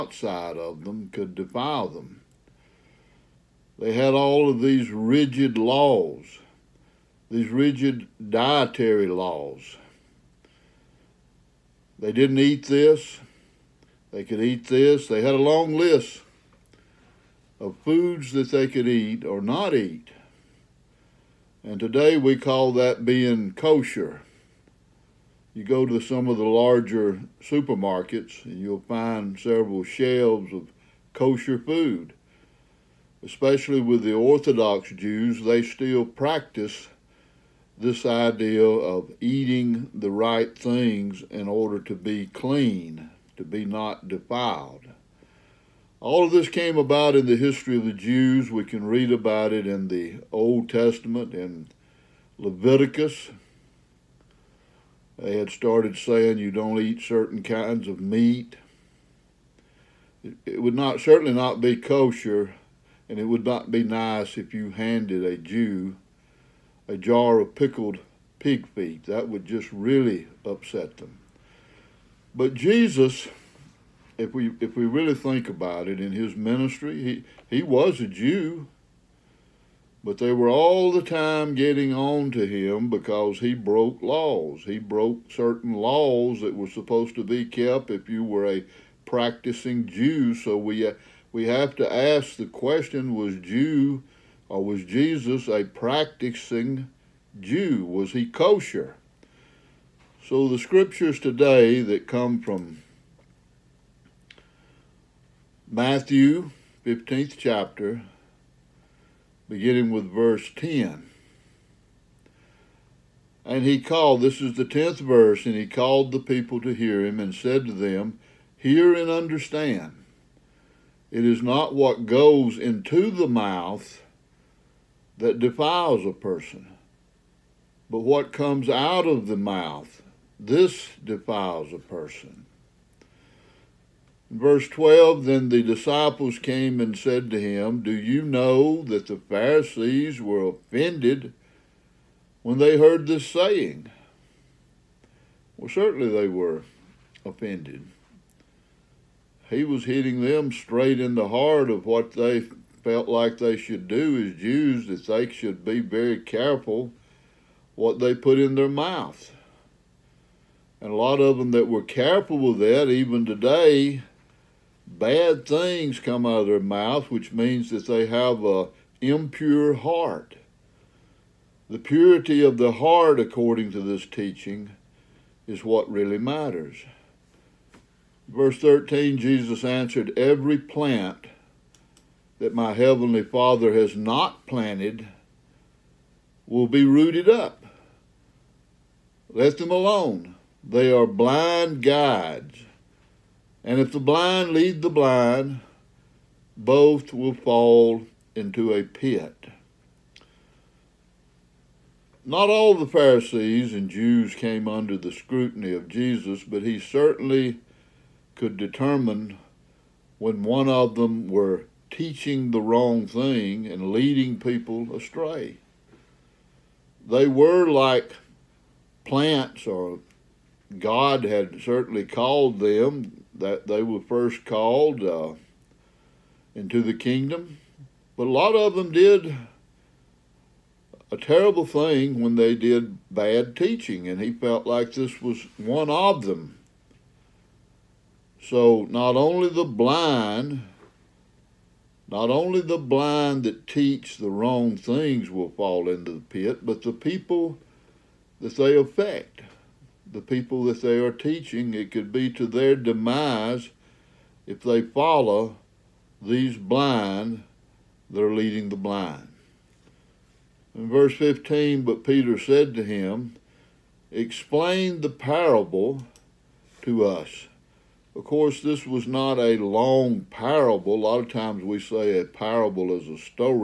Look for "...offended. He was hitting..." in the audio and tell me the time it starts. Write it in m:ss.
2:27.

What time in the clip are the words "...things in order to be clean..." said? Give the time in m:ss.
0:40.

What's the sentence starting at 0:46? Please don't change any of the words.
All of this came about in the history of the Jews.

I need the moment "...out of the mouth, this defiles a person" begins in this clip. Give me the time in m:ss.
2:08.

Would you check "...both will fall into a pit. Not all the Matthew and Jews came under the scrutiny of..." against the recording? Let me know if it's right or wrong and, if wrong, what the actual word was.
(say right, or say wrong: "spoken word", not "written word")
wrong: "Pharisees", not "Matthew".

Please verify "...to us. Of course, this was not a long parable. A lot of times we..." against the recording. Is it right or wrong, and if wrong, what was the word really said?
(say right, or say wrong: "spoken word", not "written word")
right.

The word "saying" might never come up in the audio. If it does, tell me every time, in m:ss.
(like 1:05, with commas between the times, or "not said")
0:55, 2:23.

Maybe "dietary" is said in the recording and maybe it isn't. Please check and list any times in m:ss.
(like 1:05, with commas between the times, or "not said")
0:08.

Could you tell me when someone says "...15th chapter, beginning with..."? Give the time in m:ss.
1:46.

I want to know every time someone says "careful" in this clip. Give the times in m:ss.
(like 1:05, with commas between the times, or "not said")
2:36, 2:41.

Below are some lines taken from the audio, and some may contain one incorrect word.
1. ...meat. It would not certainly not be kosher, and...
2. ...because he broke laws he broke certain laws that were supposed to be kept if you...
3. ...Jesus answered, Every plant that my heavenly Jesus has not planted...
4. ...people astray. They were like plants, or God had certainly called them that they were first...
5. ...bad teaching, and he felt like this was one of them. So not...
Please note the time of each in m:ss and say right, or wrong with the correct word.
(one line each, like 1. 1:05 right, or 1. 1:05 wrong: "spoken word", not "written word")
1. 0:57 right
2. 1:22 right
3. 2:59 wrong: "Father", not "Jesus"
4. 3:34 right
5. 3:53 right.